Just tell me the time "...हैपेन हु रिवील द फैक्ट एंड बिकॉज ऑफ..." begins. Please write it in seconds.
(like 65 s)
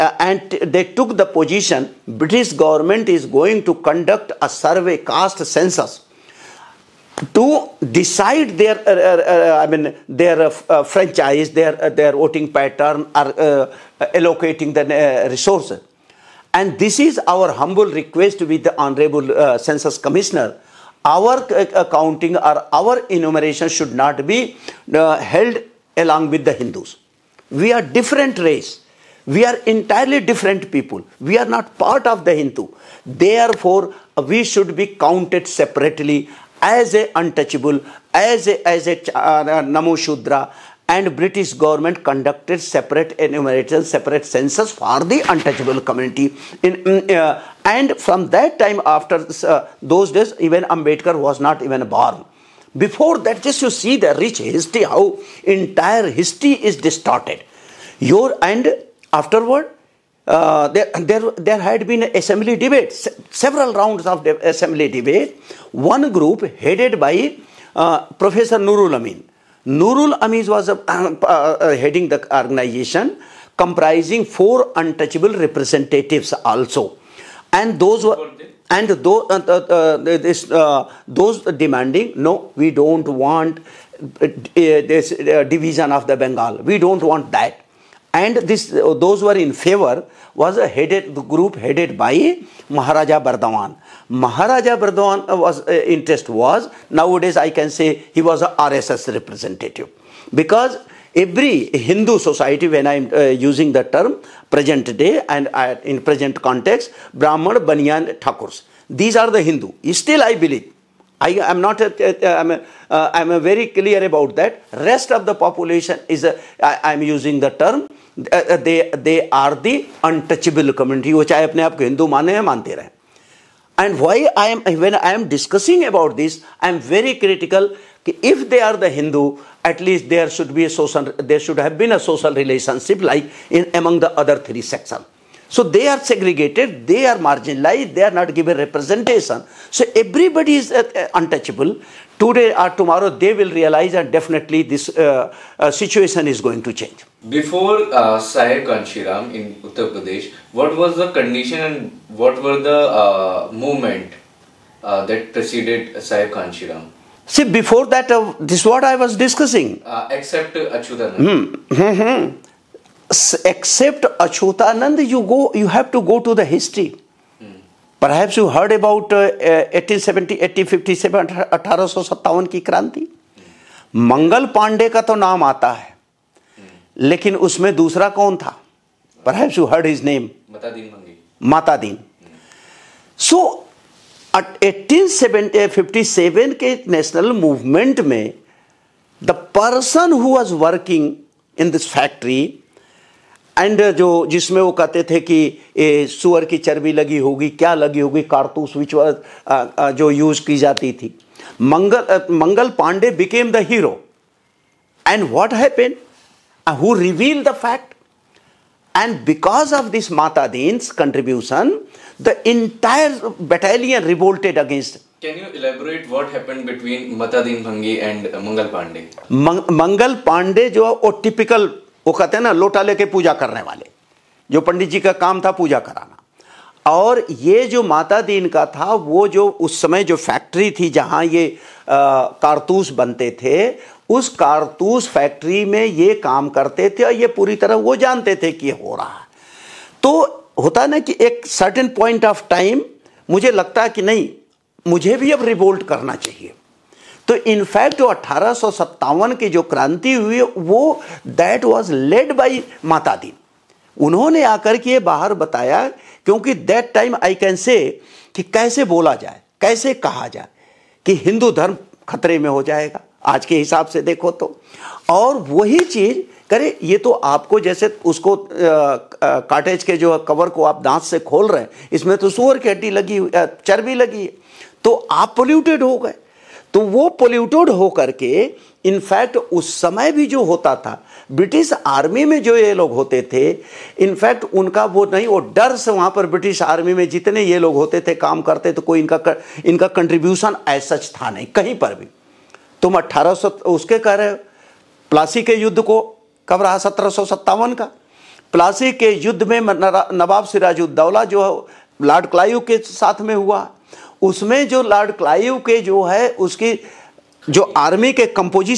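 205 s.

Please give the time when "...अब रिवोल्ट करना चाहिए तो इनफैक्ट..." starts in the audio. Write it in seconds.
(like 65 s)
245 s.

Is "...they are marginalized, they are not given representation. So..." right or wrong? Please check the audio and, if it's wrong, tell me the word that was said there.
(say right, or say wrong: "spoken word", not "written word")
right.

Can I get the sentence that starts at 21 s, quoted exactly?
Our uh, uh, counting or our enumeration should not be uh, held along with the Hindus.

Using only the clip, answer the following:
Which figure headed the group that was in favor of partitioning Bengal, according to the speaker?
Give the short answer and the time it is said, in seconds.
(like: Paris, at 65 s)
Maharaja Bardhaman, at 92 s.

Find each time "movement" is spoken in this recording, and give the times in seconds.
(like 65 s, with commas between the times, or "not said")
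153 s.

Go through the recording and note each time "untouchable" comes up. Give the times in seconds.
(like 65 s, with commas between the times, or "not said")
37 s, 45 s, 74 s, 120 s, 141 s.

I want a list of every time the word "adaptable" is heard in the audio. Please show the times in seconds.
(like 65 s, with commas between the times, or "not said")
not said.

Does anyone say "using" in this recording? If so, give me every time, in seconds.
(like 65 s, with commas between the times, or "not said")
103 s, 117 s.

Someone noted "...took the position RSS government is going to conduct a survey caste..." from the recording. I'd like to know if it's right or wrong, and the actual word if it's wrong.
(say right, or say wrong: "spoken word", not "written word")
wrong: "British", not "RSS".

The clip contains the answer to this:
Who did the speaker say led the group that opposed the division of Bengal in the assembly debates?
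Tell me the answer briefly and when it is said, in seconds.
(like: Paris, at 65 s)
Nurul Amin, at 68 s.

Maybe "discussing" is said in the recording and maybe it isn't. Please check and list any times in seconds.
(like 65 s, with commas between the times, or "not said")
125 s, 159 s.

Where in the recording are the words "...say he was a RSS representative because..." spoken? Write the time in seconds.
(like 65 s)
97 s.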